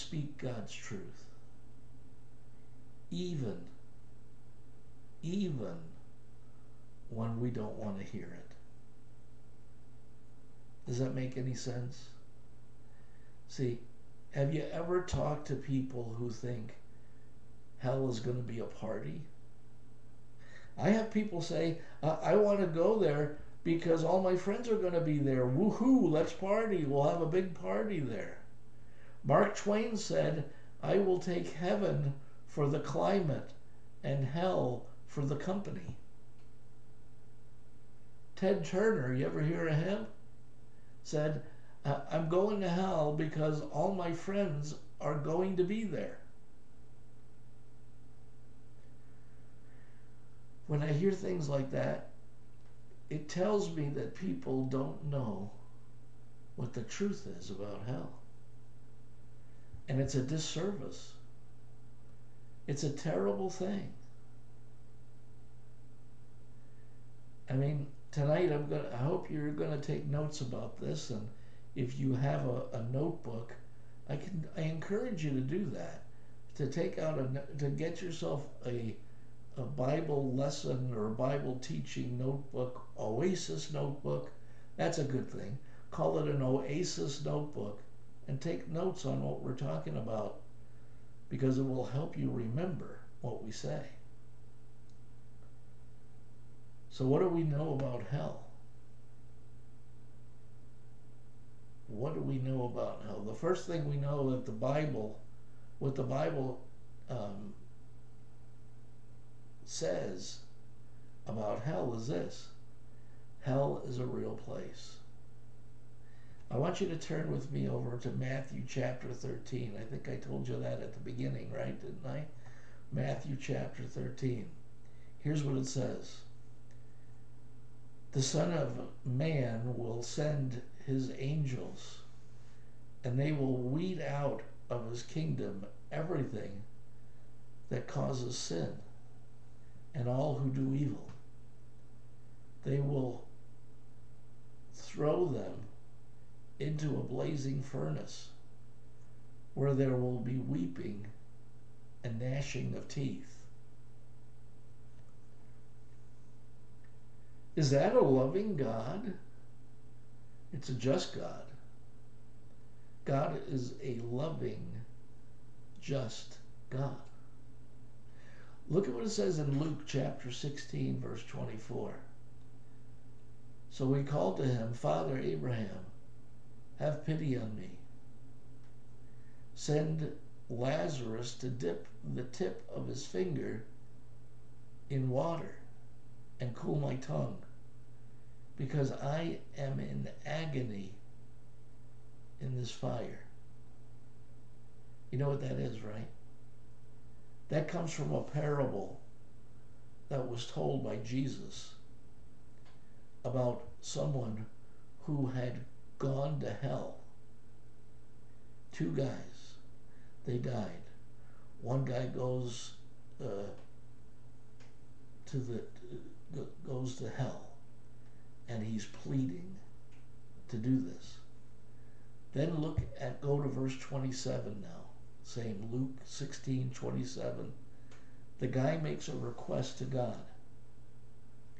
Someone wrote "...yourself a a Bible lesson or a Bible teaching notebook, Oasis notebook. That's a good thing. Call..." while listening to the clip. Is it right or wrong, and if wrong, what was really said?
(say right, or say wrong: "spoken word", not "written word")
right.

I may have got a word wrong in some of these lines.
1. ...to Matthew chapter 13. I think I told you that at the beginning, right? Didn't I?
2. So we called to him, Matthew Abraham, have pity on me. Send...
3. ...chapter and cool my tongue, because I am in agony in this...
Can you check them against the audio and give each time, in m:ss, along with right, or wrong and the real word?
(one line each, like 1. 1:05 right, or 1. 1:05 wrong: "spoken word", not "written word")
1. 1:57 right
2. 2:53 wrong: "Father", not "Matthew"
3. 3:05 wrong: "water", not "chapter".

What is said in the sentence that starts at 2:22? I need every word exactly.
They will throw them into a blazing furnace where there will be weeping and gnashing of teeth.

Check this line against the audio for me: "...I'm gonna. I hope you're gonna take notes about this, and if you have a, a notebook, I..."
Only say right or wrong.
right.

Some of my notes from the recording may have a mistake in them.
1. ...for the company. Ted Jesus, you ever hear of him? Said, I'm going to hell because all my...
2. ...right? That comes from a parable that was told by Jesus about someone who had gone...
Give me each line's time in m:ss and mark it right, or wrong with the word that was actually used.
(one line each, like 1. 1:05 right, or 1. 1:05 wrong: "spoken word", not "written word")
1. 0:35 wrong: "Turner", not "Jesus"
2. 3:15 right.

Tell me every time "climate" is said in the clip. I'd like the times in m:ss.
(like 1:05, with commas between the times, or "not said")
0:32.